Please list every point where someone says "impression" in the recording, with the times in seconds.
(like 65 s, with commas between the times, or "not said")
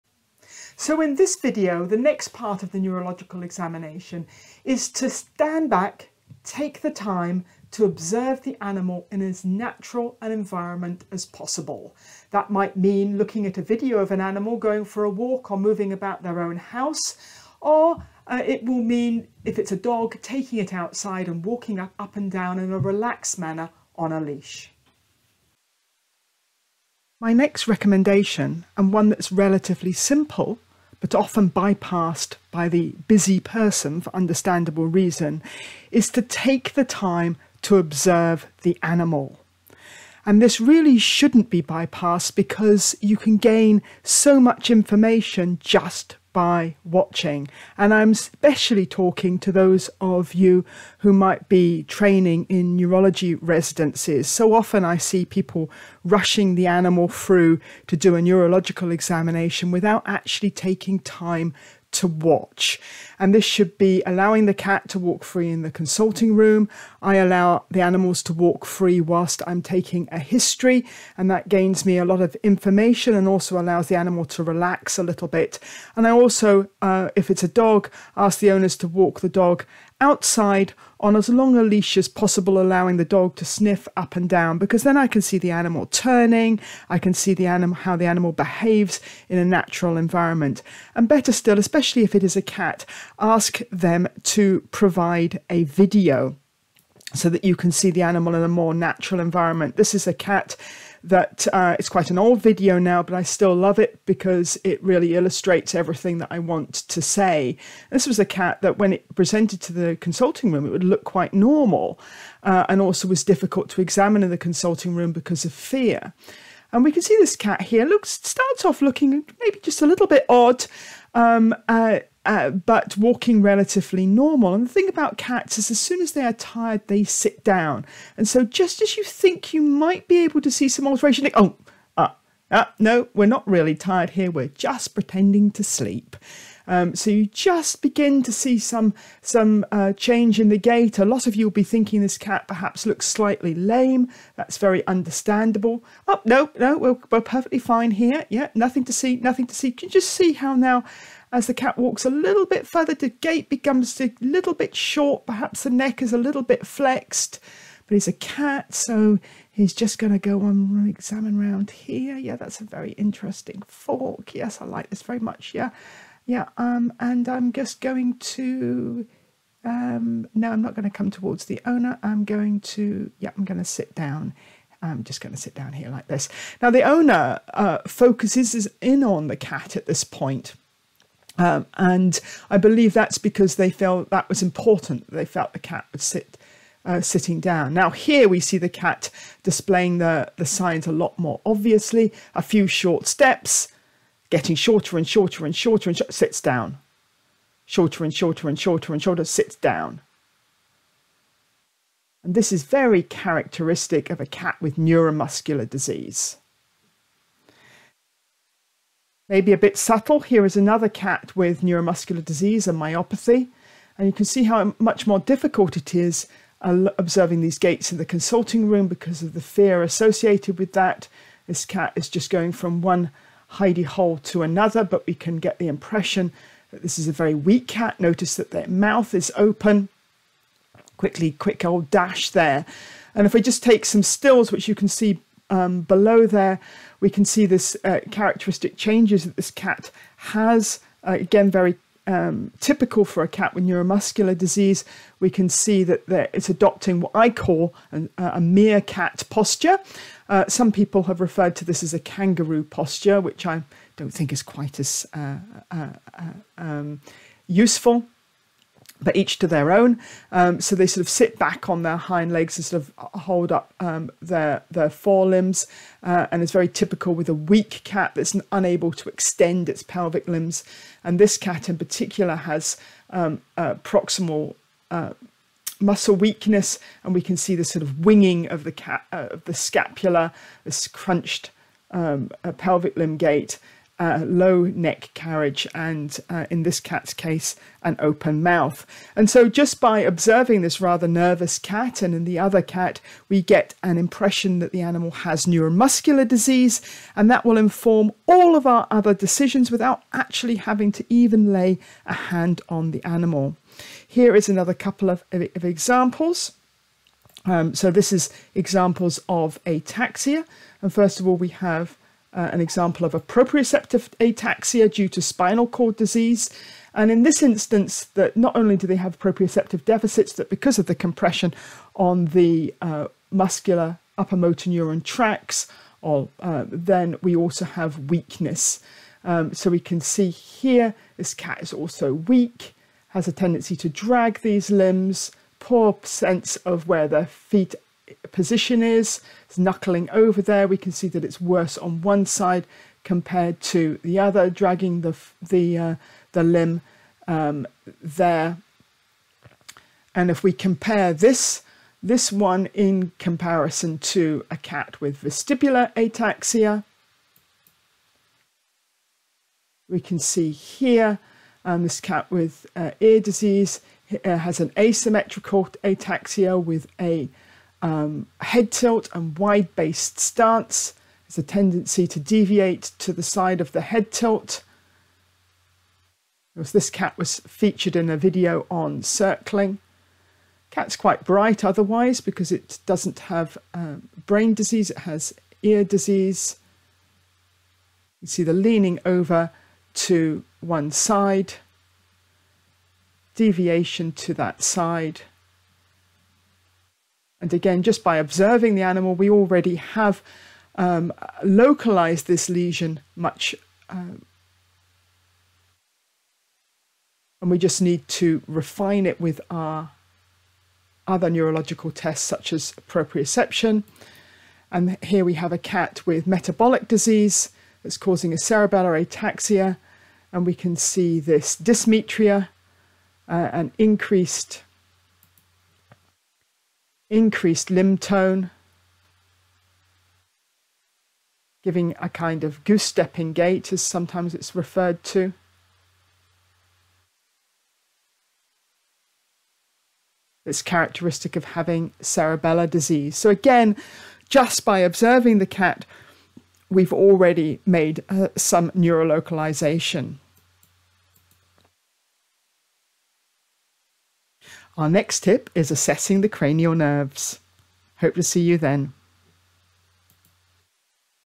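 225 s, 293 s.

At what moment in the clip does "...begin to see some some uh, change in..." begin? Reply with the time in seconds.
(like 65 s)
137 s.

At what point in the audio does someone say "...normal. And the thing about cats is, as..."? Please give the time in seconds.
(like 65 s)
124 s.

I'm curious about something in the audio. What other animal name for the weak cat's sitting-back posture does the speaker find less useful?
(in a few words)
Kangaroo posture.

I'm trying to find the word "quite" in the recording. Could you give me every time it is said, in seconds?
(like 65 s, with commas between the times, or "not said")
101 s, 111 s, 254 s, 380 s.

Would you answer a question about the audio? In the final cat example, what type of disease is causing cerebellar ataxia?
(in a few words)
Metabolic disease.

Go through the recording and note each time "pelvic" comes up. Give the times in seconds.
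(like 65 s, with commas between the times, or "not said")
269 s, 282 s.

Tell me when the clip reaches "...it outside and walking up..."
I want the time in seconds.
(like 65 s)
20 s.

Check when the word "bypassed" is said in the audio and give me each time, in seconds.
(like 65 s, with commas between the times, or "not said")
31 s, 41 s.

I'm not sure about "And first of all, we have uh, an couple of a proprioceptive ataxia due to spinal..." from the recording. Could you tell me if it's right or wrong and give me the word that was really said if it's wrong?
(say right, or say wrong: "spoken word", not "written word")
wrong: "example", not "couple".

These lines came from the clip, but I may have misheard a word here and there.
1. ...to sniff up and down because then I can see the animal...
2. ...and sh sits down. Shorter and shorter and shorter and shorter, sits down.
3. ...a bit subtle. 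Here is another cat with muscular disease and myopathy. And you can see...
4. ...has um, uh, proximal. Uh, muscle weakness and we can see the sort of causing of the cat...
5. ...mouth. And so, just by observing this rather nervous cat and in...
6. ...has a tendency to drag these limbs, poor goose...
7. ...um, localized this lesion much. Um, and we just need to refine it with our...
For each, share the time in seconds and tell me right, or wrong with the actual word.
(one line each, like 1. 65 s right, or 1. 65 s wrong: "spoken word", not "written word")
1. 83 s right
2. 195 s right
3. 209 s wrong: "neuromuscular", not "muscular"
4. 272 s wrong: "winging", not "causing"
5. 288 s right
6. 333 s wrong: "sense", not "goose"
7. 400 s right.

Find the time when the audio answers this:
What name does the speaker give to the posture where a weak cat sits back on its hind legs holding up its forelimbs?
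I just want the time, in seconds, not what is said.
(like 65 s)
248 s.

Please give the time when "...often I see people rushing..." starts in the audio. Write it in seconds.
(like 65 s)
54 s.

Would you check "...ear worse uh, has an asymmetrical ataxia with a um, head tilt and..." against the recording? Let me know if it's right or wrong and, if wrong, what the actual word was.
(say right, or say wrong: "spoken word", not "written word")
wrong: "disease", not "worse".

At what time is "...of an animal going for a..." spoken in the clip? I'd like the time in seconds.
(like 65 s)
13 s.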